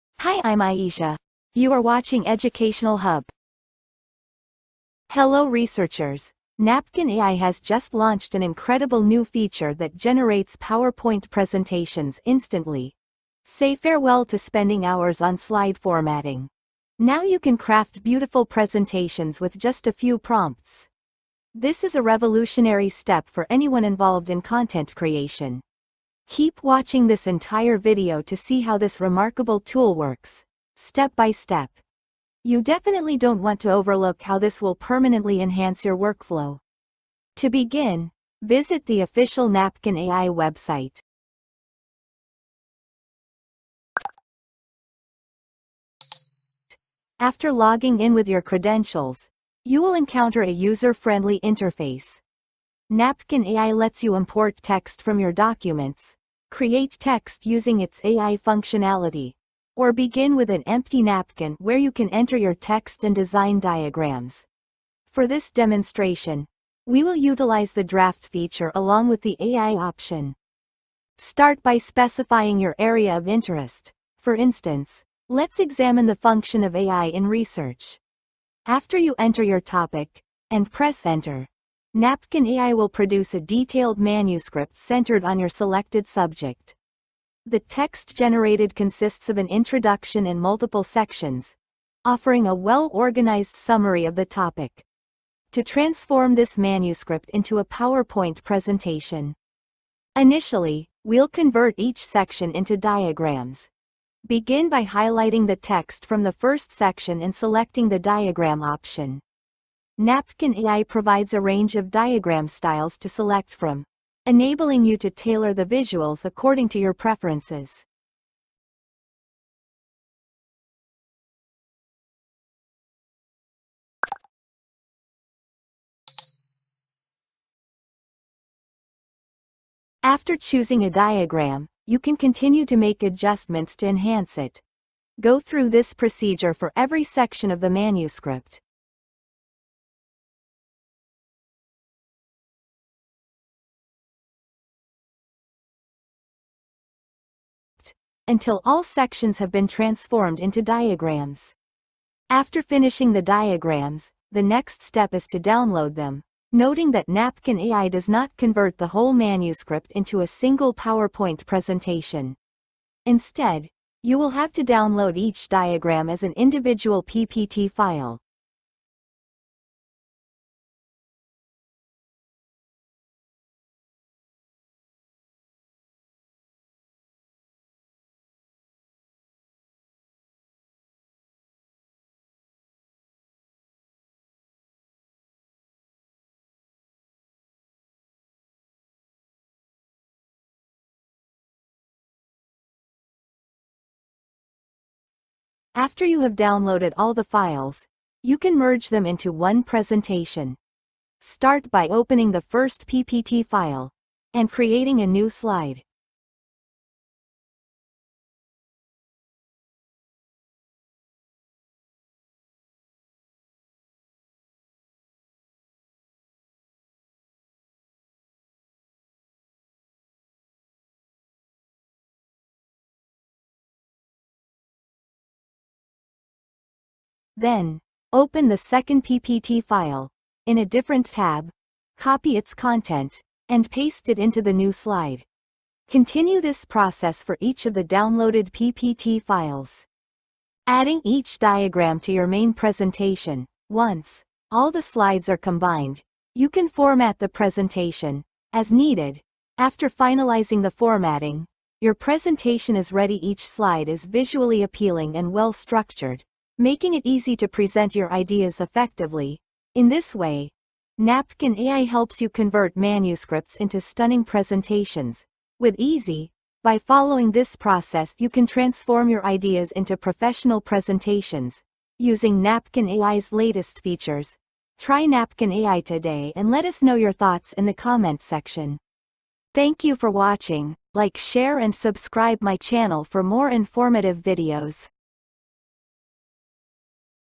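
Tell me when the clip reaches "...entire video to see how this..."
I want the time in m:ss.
0:27.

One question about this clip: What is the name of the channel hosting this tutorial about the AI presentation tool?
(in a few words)
Educational Hub.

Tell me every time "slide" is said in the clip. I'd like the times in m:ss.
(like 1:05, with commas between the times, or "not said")
0:15, 3:25, 3:54, 4:04, 4:13.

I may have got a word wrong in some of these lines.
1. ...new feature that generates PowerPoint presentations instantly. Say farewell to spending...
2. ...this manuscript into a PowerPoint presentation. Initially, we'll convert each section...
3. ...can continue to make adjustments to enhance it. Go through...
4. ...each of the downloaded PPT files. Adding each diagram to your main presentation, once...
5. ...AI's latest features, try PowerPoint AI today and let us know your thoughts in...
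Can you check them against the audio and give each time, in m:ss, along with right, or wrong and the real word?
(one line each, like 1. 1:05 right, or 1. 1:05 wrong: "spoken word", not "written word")
1. 0:09 right
2. 1:36 right
3. 2:11 right
4. 3:57 right
5. 4:32 wrong: "Napkin", not "PowerPoint".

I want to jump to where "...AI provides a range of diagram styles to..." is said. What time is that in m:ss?
1:50.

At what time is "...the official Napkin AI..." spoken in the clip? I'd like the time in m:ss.
0:38.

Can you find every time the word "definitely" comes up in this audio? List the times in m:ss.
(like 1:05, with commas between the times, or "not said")
0:32.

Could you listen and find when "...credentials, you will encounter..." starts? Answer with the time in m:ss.
0:48.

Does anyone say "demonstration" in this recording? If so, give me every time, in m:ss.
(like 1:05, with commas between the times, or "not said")
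1:05.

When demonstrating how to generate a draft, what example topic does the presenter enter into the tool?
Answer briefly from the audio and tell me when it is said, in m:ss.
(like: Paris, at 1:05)
AI in research, at 1:16.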